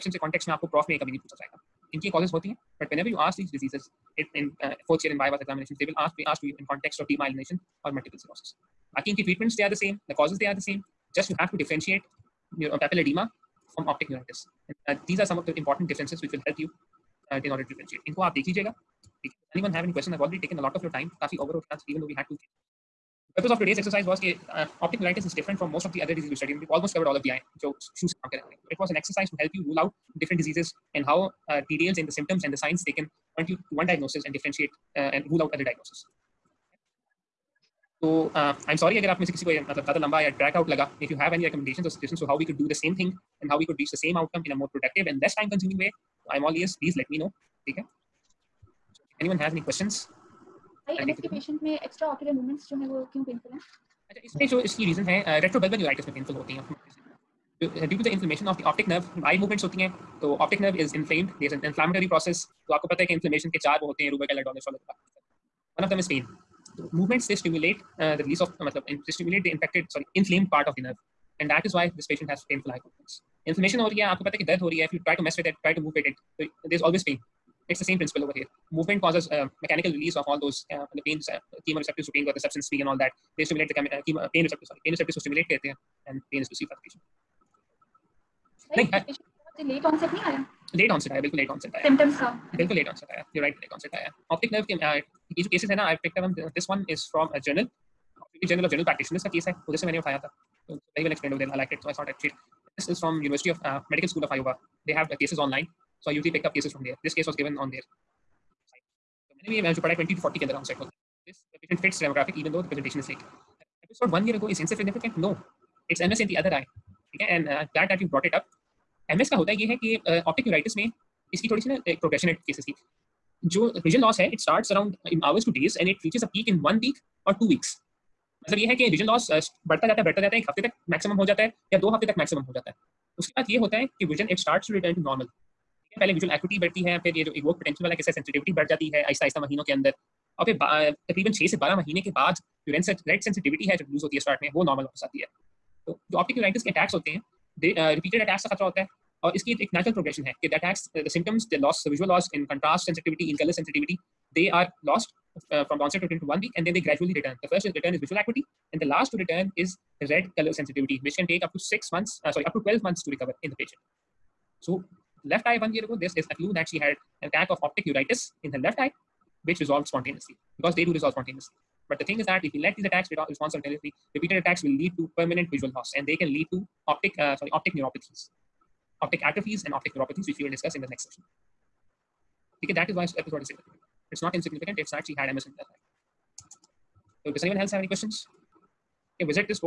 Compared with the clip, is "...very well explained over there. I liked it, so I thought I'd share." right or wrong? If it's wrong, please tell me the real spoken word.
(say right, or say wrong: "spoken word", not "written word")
right.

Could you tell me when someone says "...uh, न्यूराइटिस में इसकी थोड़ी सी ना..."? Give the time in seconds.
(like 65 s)
120 s.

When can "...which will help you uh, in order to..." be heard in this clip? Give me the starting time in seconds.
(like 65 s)
16 s.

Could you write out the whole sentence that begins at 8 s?
Akinki treatments, they are the same.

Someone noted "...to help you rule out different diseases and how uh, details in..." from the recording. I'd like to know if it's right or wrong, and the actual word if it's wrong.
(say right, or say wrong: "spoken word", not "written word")
right.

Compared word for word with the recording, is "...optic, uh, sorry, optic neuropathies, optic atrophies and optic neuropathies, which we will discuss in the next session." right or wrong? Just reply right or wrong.
right.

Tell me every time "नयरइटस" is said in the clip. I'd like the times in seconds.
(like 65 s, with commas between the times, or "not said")
55 s, 120 s, 146 s.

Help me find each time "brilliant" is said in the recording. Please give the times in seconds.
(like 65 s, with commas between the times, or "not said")
not said.